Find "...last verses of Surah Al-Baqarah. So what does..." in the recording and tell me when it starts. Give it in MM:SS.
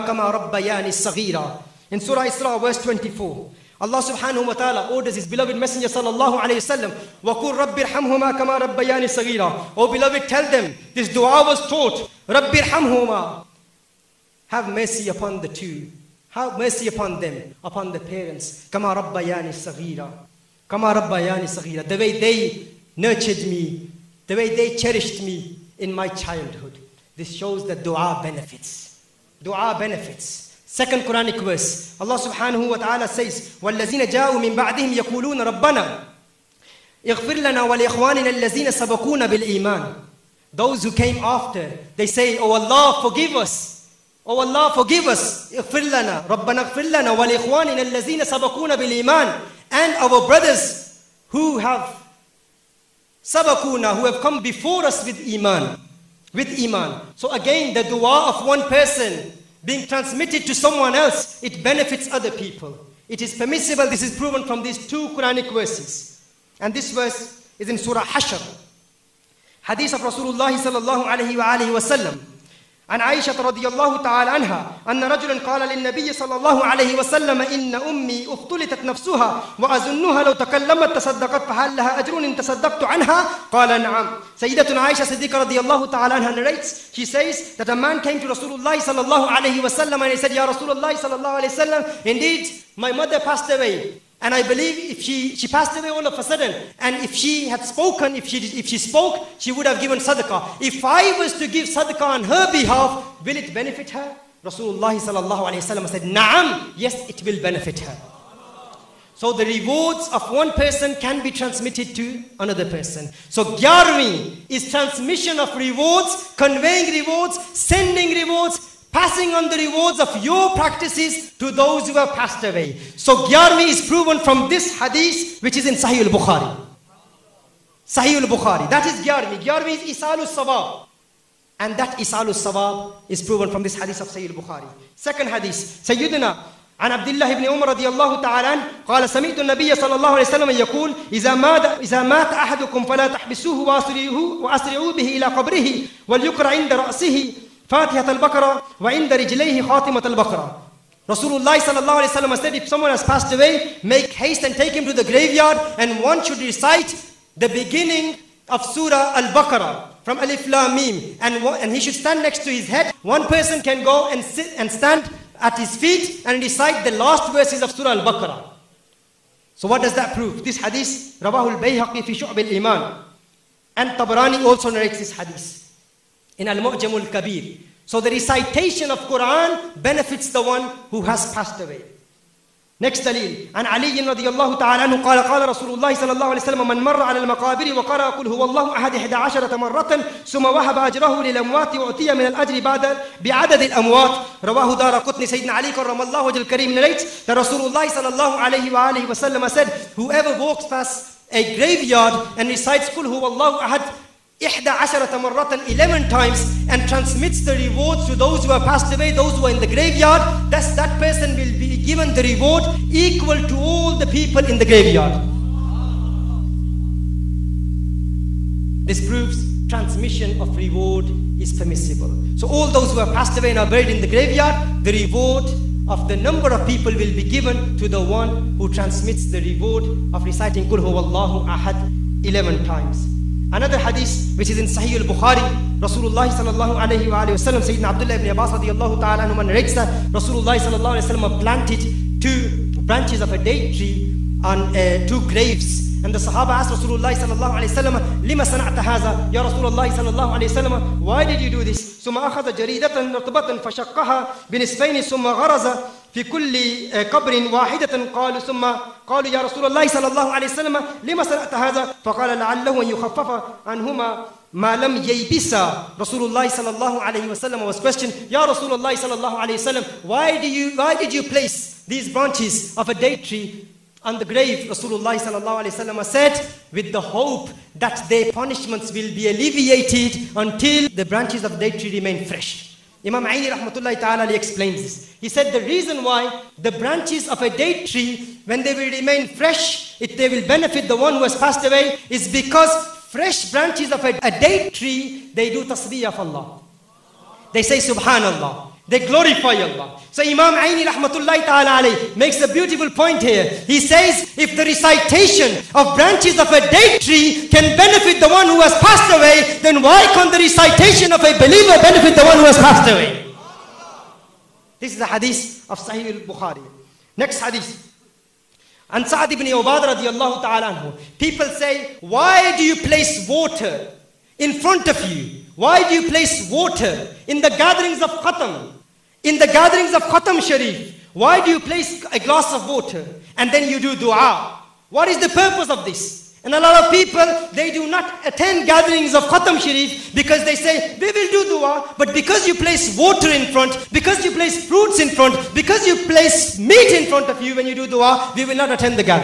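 02:46.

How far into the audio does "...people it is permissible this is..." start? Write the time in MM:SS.
01:02.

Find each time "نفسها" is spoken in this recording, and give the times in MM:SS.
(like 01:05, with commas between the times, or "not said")
01:18.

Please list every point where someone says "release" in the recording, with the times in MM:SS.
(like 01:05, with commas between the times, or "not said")
not said.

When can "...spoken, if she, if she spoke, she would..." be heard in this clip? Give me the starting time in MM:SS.
01:37.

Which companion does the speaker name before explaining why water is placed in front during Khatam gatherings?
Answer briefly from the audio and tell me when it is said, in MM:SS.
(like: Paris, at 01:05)
Sa'ad ibn Ubad, at 05:19.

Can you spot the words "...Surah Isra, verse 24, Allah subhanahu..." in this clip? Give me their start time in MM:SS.
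00:01.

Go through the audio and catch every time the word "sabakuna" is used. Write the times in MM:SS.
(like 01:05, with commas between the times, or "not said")
00:48, 00:53.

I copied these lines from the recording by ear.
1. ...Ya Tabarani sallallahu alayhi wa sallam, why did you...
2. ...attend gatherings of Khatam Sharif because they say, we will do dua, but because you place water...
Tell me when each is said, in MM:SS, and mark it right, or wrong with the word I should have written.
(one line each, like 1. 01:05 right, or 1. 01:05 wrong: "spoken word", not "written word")
1. 04:09 wrong: "Rasulullah", not "Tabarani"
2. 05:38 right.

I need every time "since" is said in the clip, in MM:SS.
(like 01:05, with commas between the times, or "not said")
not said.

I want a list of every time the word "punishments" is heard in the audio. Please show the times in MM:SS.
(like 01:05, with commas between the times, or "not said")
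04:38.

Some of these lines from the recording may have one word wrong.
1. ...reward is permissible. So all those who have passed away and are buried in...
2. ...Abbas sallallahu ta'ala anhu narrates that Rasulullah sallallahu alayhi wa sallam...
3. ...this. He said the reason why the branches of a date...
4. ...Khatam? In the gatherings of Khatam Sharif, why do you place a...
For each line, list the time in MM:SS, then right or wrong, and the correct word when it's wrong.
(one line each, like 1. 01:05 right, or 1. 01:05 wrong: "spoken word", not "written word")
1. 03:40 right
2. 03:58 wrong: "radiallahu", not "sallallahu"
3. 04:44 right
4. 05:28 right.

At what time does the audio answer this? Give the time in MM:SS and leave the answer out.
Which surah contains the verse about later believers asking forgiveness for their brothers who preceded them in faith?
01:07.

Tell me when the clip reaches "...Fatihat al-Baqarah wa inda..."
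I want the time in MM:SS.
02:27.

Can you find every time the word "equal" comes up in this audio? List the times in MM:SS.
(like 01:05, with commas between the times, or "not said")
03:32.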